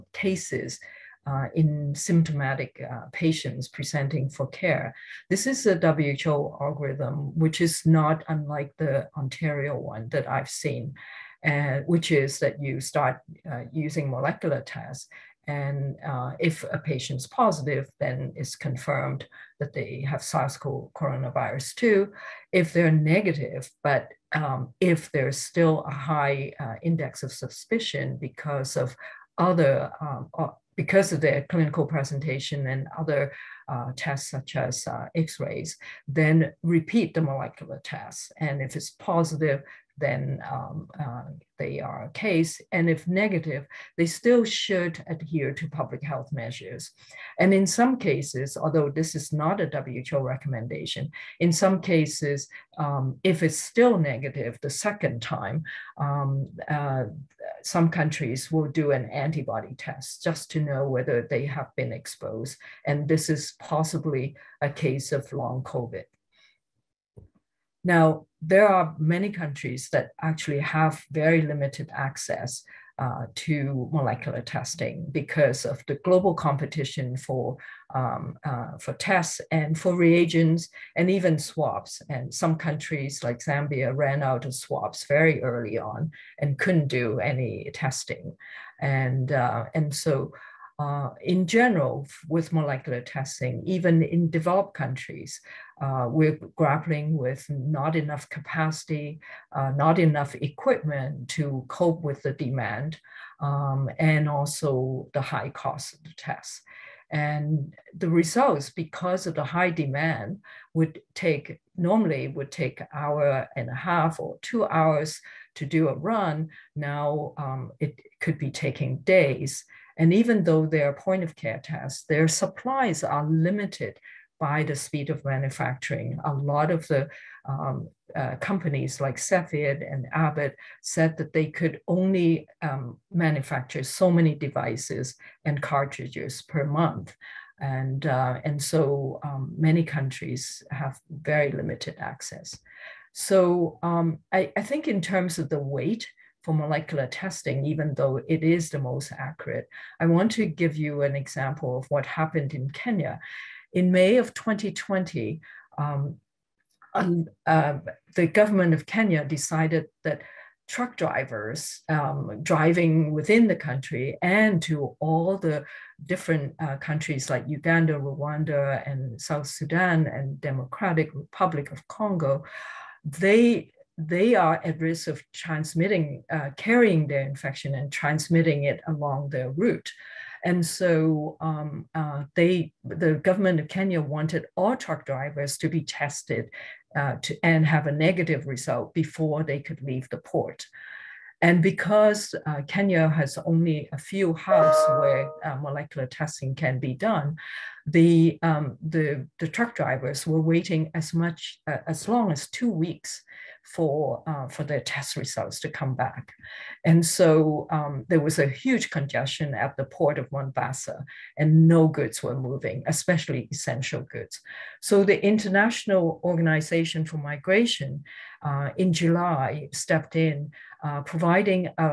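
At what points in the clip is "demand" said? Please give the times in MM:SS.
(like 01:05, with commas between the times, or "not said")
01:42, 01:49.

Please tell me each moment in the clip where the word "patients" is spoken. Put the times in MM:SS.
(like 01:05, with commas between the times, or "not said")
00:03, 00:16.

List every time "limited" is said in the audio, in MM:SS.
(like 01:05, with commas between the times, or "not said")
01:11, 02:03, 02:21.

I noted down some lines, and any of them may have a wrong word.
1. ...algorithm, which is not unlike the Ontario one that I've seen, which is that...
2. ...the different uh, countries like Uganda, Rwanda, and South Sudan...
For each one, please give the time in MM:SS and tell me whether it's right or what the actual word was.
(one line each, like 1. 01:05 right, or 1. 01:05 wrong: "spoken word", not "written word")
1. 00:06 right
2. 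02:45 right.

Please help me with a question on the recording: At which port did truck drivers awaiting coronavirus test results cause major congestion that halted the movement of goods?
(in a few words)
Mombasa.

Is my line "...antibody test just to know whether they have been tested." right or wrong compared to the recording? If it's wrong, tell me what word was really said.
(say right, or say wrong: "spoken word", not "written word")
wrong: "exposed", not "tested".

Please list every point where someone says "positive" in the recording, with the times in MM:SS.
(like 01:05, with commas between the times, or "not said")
00:17, 00:38.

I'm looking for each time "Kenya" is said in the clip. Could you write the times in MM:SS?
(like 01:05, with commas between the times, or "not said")
02:32, 02:38, 03:03, 03:12.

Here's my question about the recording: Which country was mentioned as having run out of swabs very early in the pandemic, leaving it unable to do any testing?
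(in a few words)
Zambia.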